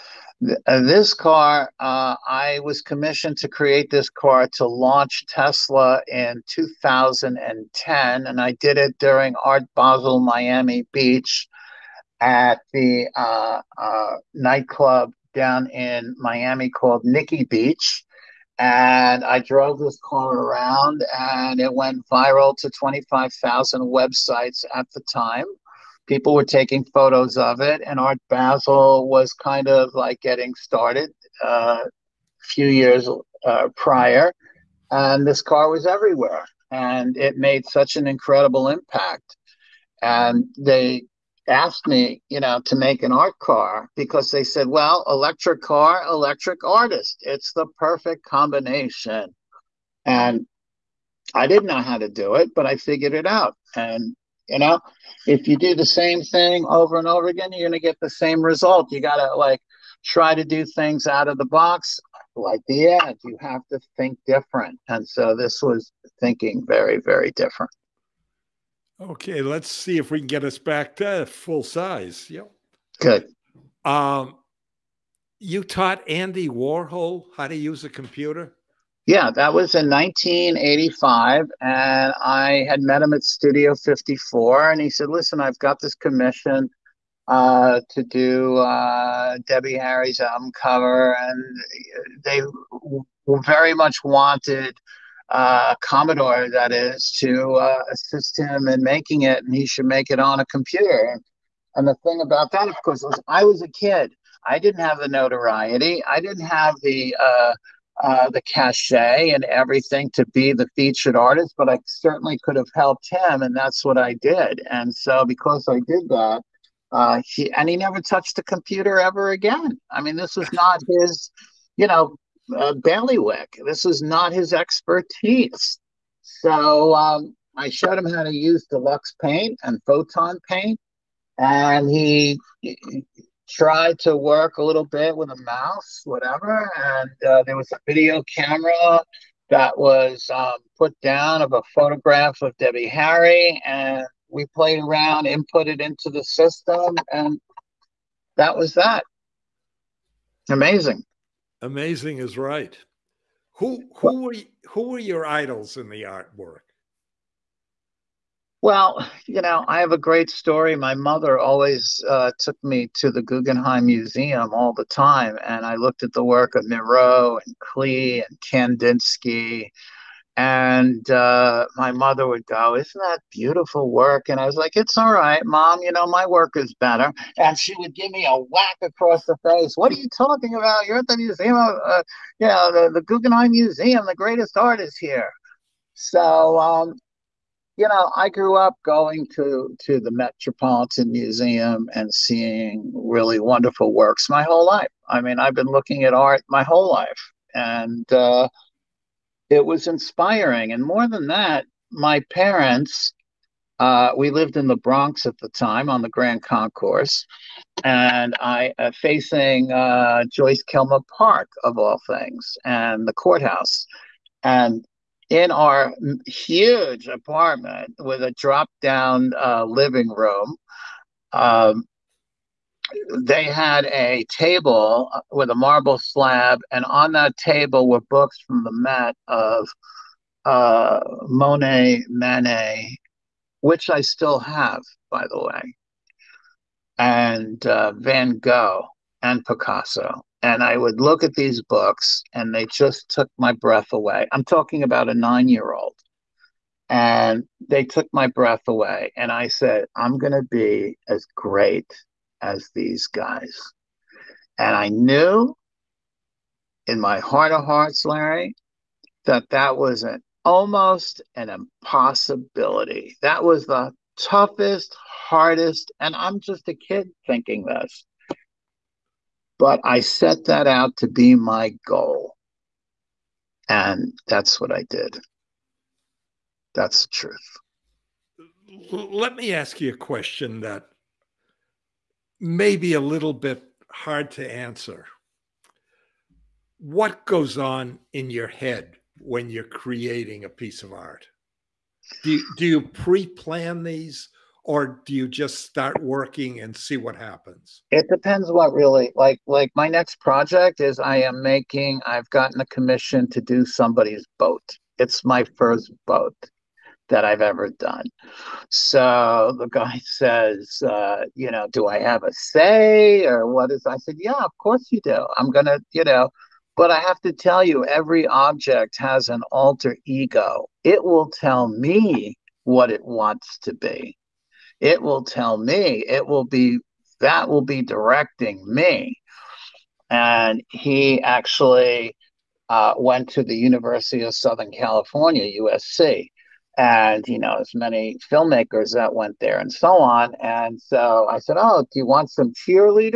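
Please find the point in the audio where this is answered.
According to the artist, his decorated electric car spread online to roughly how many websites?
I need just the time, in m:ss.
0:22.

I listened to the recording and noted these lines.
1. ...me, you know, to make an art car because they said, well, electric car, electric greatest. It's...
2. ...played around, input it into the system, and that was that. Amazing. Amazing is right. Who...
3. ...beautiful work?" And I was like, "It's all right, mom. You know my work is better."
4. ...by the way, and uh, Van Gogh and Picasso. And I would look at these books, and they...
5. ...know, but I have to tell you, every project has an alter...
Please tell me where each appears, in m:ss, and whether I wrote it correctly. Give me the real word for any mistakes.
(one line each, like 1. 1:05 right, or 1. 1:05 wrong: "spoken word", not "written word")
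1. 0:41 wrong: "artist", not "greatest"
2. 2:24 right
3. 2:53 right
4. 3:55 right
5. 5:16 wrong: "object", not "project".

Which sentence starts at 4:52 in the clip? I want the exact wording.
Do you, do you pre-plan these or do you just start working and see what happens?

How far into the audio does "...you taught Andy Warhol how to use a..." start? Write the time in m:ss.
1:15.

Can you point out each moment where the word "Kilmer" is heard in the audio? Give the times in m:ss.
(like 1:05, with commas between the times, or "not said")
3:30.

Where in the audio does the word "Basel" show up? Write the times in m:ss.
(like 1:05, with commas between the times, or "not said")
0:09, 0:28.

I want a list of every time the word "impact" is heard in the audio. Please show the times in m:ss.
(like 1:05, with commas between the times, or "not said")
0:38.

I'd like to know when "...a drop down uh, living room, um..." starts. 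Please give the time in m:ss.
3:38.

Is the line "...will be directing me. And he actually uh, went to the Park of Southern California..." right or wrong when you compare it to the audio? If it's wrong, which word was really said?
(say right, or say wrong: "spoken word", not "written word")
wrong: "University", not "Park".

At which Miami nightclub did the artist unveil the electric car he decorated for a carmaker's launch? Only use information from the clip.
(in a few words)
Nikki Beach.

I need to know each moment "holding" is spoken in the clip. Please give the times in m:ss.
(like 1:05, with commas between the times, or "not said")
not said.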